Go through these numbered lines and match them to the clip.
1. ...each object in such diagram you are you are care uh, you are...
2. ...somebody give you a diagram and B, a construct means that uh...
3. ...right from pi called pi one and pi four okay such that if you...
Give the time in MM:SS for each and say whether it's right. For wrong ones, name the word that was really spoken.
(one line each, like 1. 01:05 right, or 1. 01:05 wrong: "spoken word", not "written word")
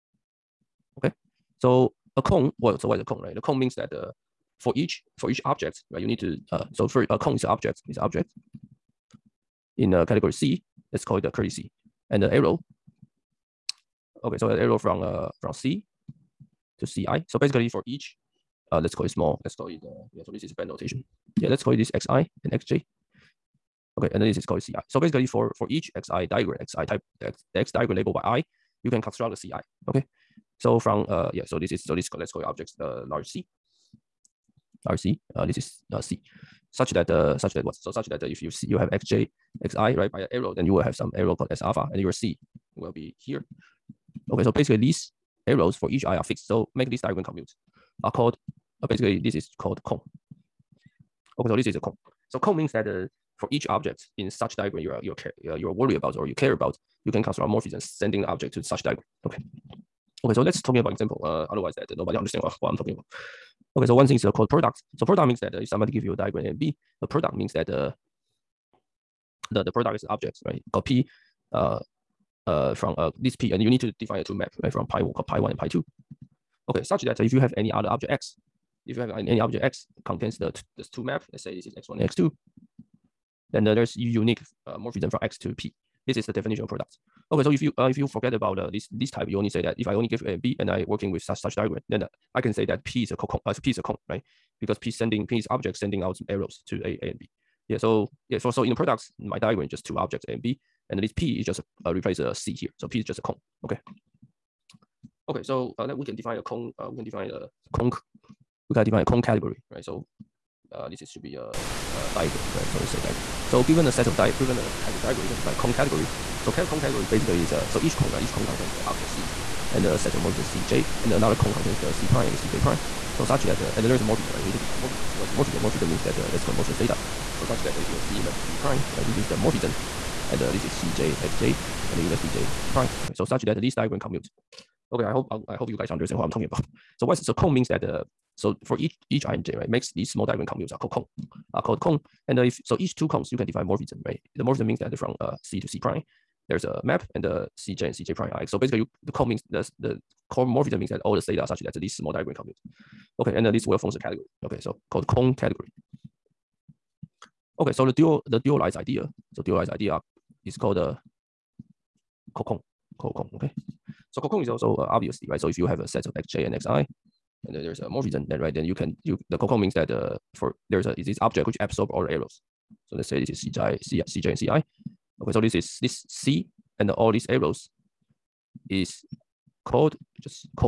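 1. 00:53 right
2. 01:05 wrong: "product", not "construct"
3. 01:14 wrong: "two", not "four".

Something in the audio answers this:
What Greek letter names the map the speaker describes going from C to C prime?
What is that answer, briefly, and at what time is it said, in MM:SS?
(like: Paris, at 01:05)
Theta, at 02:06.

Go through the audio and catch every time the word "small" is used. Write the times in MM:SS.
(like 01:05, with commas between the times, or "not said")
00:19, 02:20, 02:31.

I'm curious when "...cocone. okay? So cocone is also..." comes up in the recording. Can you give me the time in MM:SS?
02:42.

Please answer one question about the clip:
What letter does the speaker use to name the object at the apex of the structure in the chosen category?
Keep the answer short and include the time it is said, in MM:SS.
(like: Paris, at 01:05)
Curly C, at 00:11.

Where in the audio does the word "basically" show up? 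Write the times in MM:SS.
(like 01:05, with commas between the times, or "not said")
00:17, 00:24, 00:44, 00:48, 01:57, 02:28.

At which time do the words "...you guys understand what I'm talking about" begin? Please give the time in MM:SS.
02:15.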